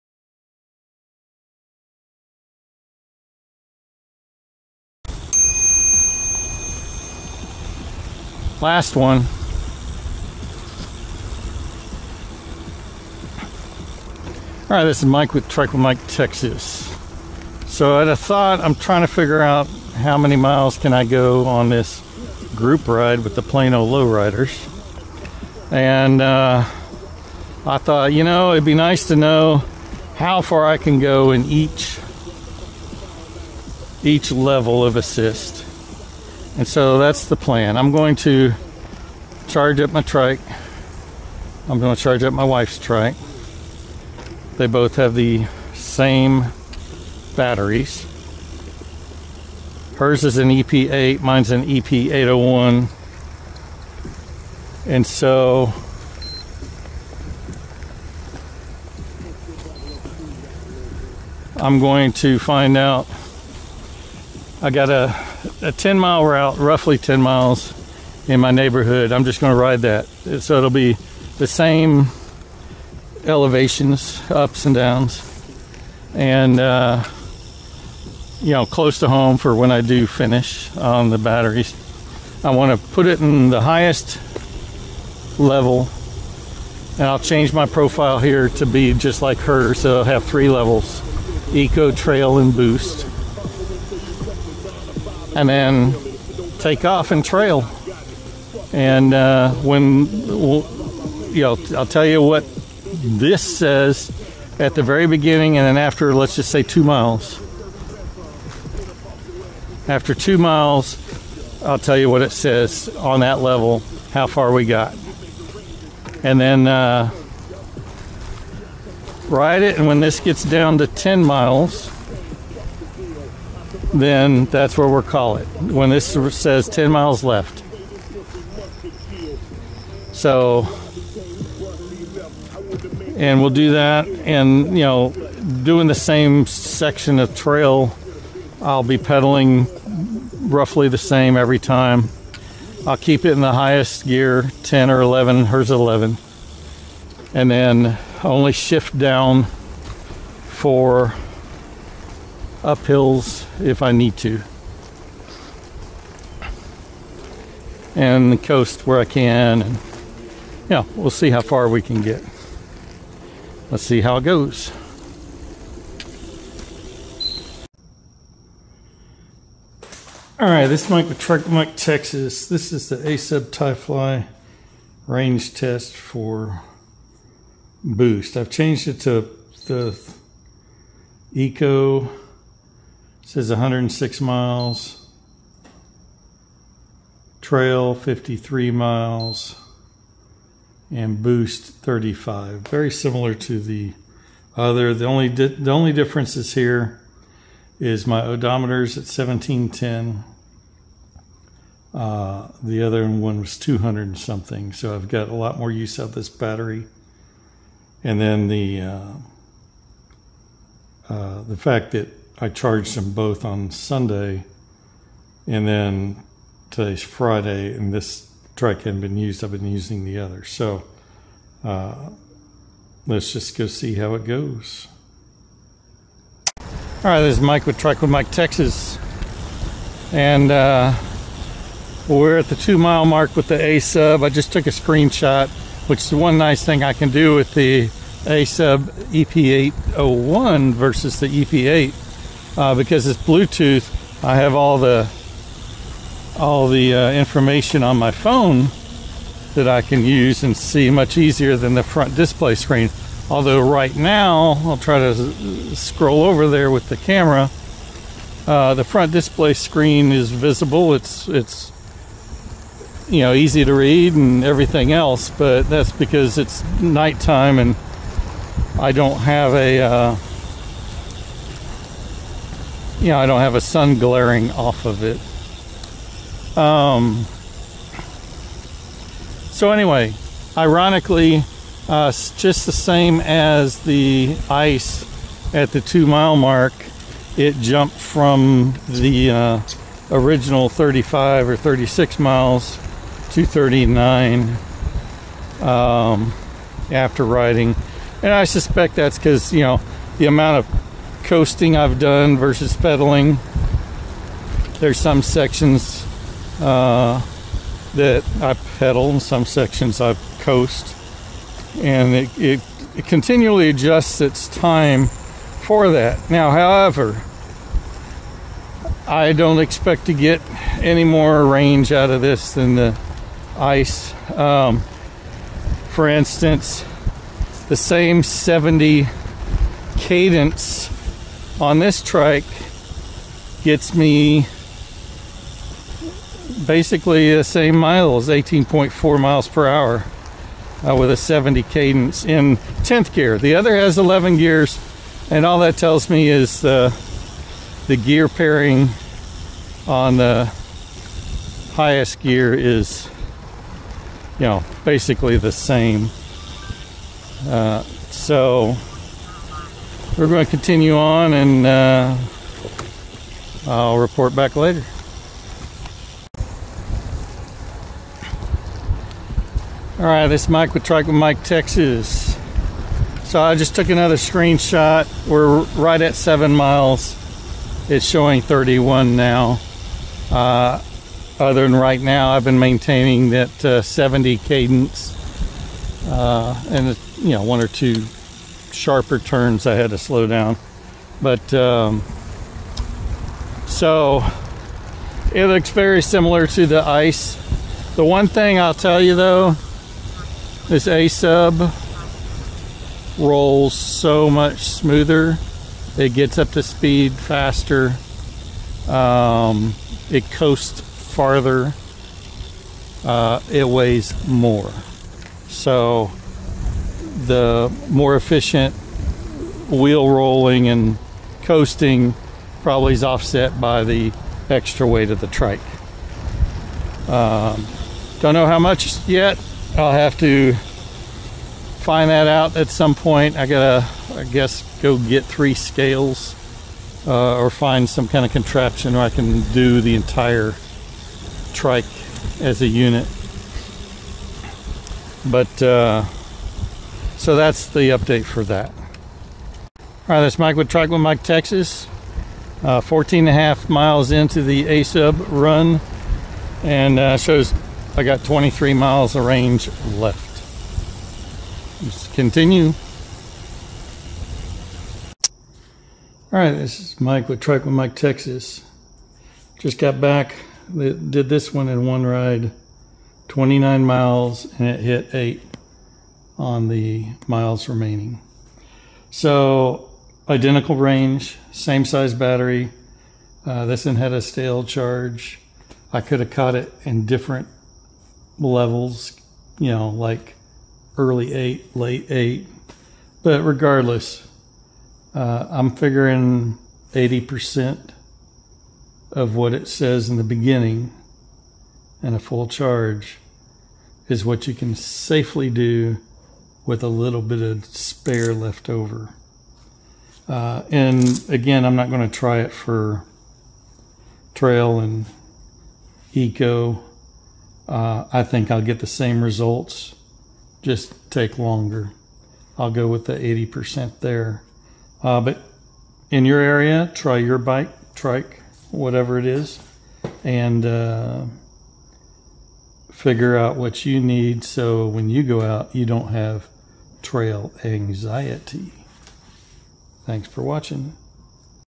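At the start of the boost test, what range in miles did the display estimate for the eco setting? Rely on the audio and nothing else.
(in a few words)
106 miles.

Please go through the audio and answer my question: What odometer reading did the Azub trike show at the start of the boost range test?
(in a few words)
1710.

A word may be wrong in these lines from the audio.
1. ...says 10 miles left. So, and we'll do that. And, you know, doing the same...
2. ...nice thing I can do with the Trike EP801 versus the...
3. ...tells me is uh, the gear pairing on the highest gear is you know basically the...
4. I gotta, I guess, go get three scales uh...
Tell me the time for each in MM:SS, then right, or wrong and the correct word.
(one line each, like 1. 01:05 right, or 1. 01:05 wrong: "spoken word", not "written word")
1. 02:06 right
2. 03:56 wrong: "Azub", not "Trike"
3. 05:45 right
4. 07:13 right.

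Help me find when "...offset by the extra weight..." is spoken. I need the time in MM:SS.
07:03.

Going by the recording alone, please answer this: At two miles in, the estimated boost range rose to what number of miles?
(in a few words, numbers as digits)
39.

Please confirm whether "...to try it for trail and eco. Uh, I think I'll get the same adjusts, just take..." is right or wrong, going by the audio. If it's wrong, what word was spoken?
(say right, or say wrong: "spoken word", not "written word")
wrong: "results", not "adjusts".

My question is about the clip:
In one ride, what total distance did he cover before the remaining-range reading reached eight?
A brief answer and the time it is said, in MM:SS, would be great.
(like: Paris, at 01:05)
29 miles, at 07:53.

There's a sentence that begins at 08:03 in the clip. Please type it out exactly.
Uh, this one had a stale charge.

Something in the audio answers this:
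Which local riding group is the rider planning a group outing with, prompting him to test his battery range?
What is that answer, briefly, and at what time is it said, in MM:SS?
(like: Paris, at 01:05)
Plano Lowriders, at 00:23.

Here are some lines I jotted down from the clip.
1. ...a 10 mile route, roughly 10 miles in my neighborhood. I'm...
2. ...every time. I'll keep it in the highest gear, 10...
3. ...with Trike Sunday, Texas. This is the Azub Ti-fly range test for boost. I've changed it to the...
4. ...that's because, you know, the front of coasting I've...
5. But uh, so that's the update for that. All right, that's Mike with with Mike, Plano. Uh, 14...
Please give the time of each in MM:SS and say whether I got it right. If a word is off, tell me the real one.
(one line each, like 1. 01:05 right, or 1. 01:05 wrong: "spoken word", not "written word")
1. 01:05 right
2. 02:21 right
3. 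02:51 wrong: "Mike", not "Sunday"
4. 04:58 wrong: "amount", not "front"
5. 07:25 wrong: "Texas", not "Plano".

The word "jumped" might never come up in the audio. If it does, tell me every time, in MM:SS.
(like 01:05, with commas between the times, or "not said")
04:47.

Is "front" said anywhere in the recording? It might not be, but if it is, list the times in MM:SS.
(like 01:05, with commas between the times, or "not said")
04:11, 04:18.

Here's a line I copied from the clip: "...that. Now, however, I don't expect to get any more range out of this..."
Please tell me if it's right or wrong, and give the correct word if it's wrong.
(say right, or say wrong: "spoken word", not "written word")
right.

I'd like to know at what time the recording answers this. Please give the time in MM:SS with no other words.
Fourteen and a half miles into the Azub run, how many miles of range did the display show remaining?
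07:38.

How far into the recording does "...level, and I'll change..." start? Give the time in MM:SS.
01:25.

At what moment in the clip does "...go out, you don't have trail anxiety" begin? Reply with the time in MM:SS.
08:55.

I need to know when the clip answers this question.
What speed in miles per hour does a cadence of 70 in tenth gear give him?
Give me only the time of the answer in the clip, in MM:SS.
05:38.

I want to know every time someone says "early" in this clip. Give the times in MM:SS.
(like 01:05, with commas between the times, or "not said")
08:10.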